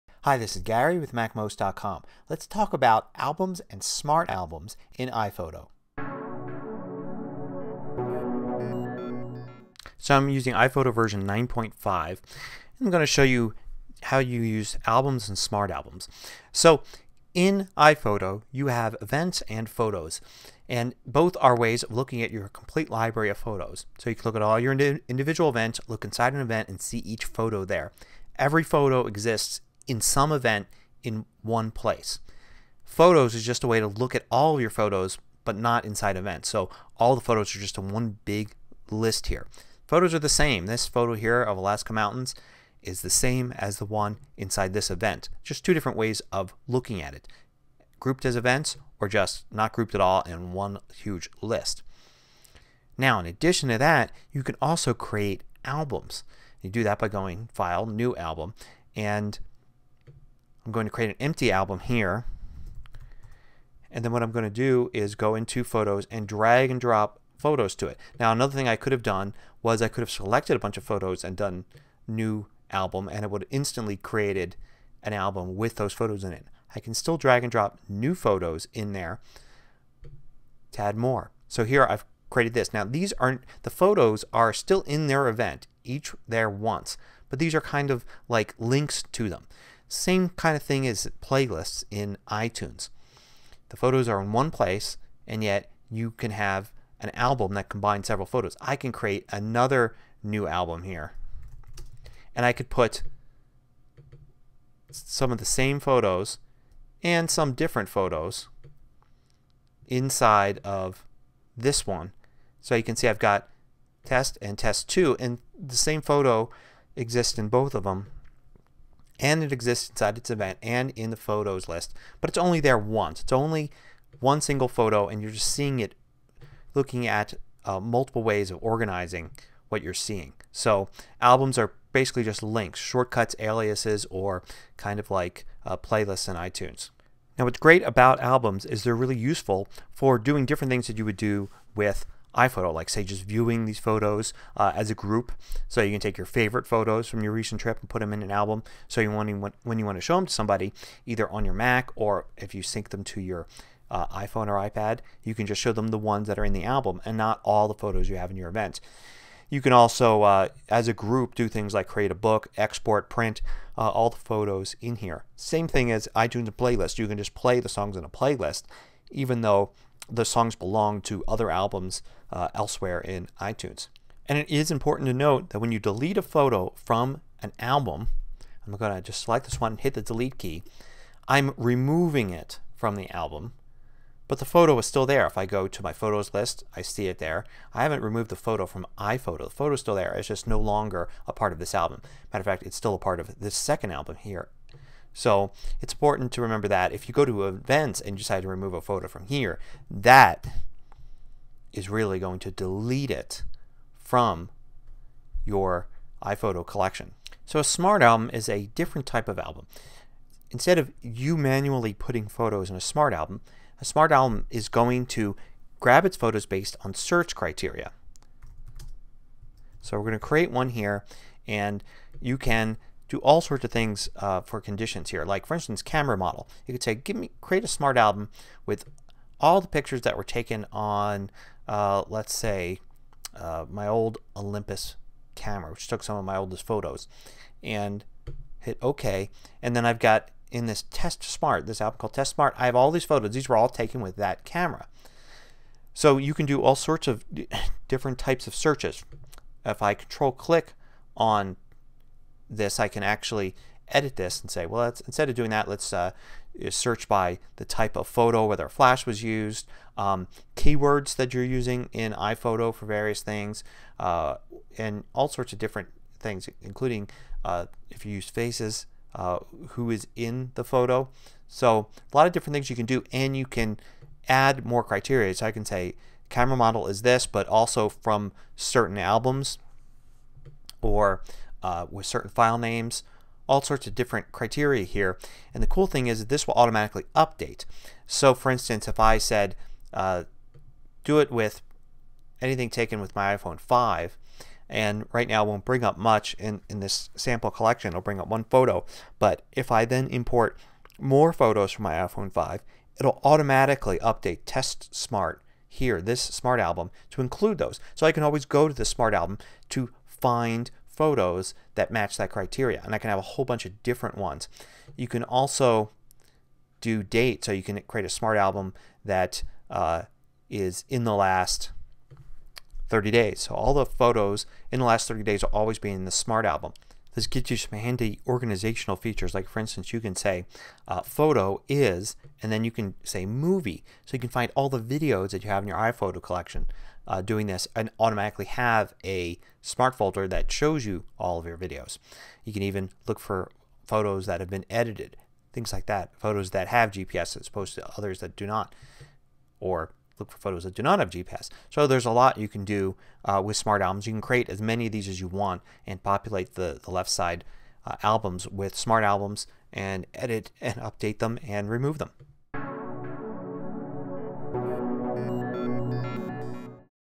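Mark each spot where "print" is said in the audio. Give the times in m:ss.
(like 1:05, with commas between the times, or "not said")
2:43.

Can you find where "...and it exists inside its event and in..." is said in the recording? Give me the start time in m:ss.
1:59.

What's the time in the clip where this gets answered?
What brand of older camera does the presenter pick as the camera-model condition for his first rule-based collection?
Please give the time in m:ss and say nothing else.
3:54.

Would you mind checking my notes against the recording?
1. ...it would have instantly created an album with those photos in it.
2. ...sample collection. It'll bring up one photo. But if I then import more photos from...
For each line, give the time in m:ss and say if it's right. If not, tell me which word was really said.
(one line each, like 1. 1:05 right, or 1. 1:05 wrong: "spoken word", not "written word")
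1. 1:13 right
2. 4:57 right.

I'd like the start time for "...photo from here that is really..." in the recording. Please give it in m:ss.
3:18.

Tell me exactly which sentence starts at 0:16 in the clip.
So in iPhoto you have events and photos and both are ways of looking at your complete library of photos.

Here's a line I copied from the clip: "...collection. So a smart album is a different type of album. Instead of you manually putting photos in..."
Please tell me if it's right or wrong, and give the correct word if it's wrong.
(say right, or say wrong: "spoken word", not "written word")
right.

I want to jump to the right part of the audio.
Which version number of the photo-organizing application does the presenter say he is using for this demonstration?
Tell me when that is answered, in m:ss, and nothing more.
0:11.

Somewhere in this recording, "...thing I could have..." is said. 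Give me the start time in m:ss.
1:08.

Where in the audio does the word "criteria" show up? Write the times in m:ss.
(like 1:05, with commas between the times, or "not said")
3:37, 4:34, 4:44, 5:12.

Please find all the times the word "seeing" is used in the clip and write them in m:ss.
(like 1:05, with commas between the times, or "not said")
2:05, 2:09.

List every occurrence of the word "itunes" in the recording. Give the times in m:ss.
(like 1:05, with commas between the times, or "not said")
1:32, 2:16, 2:46, 2:53.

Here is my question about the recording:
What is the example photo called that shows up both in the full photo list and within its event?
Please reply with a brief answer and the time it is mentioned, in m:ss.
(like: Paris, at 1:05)
Alaska Mountains, at 0:41.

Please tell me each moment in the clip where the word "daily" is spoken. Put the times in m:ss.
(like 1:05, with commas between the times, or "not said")
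not said.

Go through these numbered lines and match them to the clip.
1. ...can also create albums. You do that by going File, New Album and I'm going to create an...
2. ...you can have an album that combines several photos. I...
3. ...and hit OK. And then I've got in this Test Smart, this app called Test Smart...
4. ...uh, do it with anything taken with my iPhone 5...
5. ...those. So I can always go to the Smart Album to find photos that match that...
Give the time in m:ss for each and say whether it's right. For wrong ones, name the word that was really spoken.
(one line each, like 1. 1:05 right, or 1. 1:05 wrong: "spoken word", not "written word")
1. 0:54 right
2. 1:35 right
3. 3:57 right
4. 4:49 right
5. 5:07 right.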